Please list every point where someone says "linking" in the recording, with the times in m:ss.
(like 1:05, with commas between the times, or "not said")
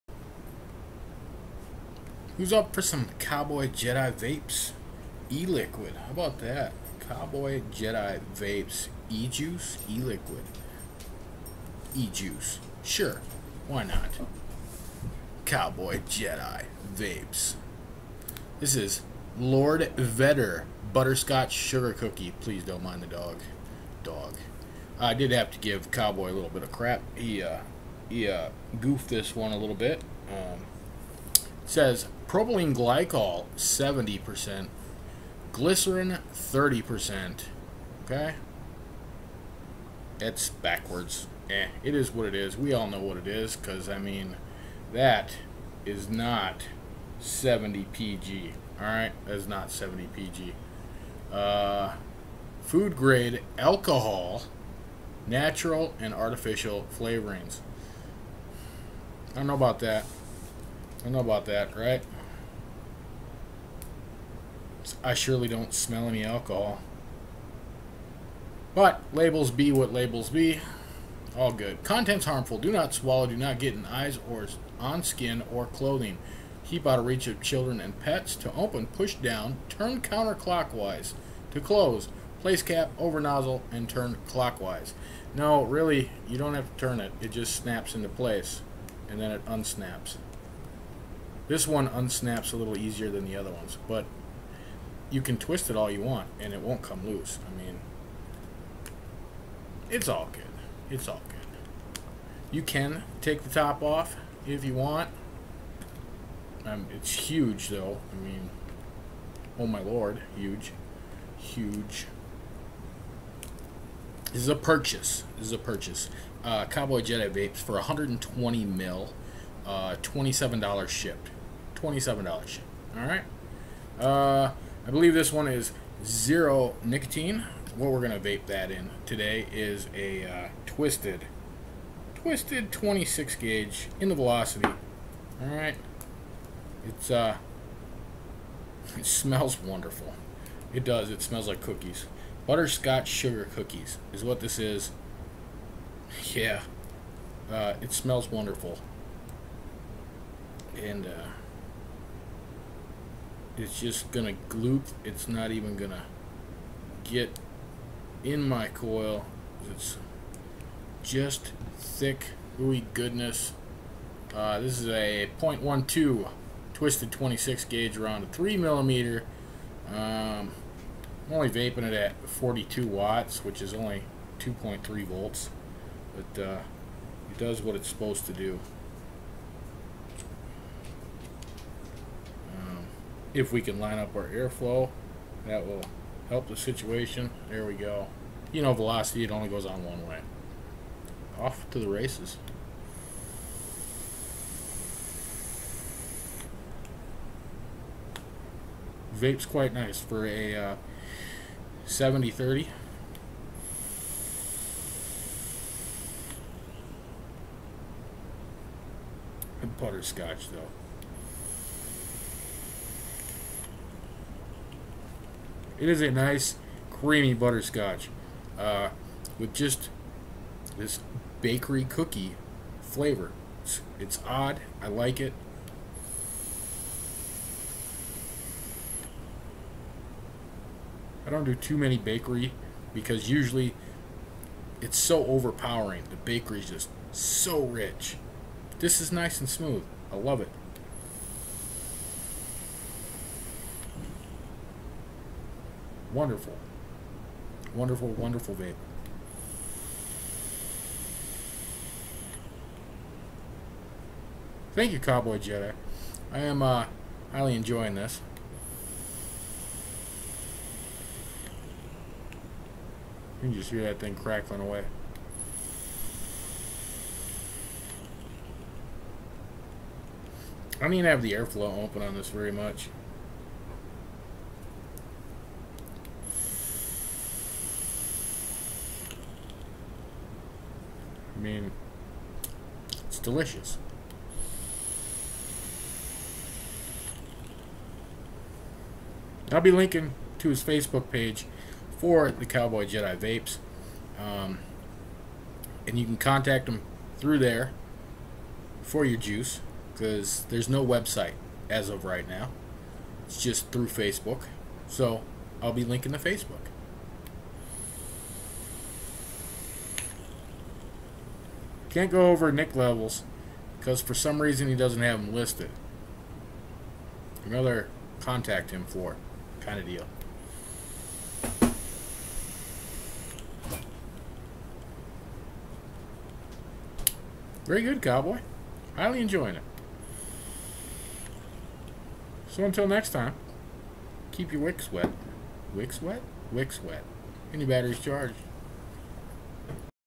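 4:49, 5:05.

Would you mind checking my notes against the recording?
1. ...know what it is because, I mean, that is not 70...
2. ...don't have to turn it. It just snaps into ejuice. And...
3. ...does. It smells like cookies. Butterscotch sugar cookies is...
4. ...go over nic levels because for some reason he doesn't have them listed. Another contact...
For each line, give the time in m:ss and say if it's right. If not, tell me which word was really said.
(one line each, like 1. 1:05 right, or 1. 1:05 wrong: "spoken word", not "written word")
1. 0:42 right
2. 1:26 wrong: "place", not "ejuice"
3. 2:20 right
4. 5:12 right.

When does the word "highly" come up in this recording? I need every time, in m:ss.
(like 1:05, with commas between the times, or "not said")
4:17, 5:28.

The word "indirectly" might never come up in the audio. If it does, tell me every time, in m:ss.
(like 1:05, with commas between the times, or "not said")
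not said.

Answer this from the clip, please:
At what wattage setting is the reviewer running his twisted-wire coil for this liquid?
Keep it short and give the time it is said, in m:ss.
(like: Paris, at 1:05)
42 watts, at 2:52.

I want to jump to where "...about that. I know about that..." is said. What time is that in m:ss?
0:59.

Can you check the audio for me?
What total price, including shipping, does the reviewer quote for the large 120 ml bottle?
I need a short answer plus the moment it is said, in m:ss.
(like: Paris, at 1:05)
$27, at 2:00.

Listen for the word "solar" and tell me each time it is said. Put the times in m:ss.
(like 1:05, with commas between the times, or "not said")
not said.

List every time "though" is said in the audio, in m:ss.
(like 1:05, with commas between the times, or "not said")
1:47, 3:30.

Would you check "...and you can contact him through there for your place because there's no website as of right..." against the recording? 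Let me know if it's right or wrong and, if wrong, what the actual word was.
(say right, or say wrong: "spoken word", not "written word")
wrong: "juice", not "place".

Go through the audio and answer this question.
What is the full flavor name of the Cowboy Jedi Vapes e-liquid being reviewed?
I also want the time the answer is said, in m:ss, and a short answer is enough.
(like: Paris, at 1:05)
Lord Vedder Butterscotch Sugar Cookie, at 0:19.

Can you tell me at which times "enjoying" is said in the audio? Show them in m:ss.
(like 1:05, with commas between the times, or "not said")
4:17, 5:29.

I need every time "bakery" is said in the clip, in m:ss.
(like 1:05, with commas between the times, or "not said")
3:41, 3:51, 3:56.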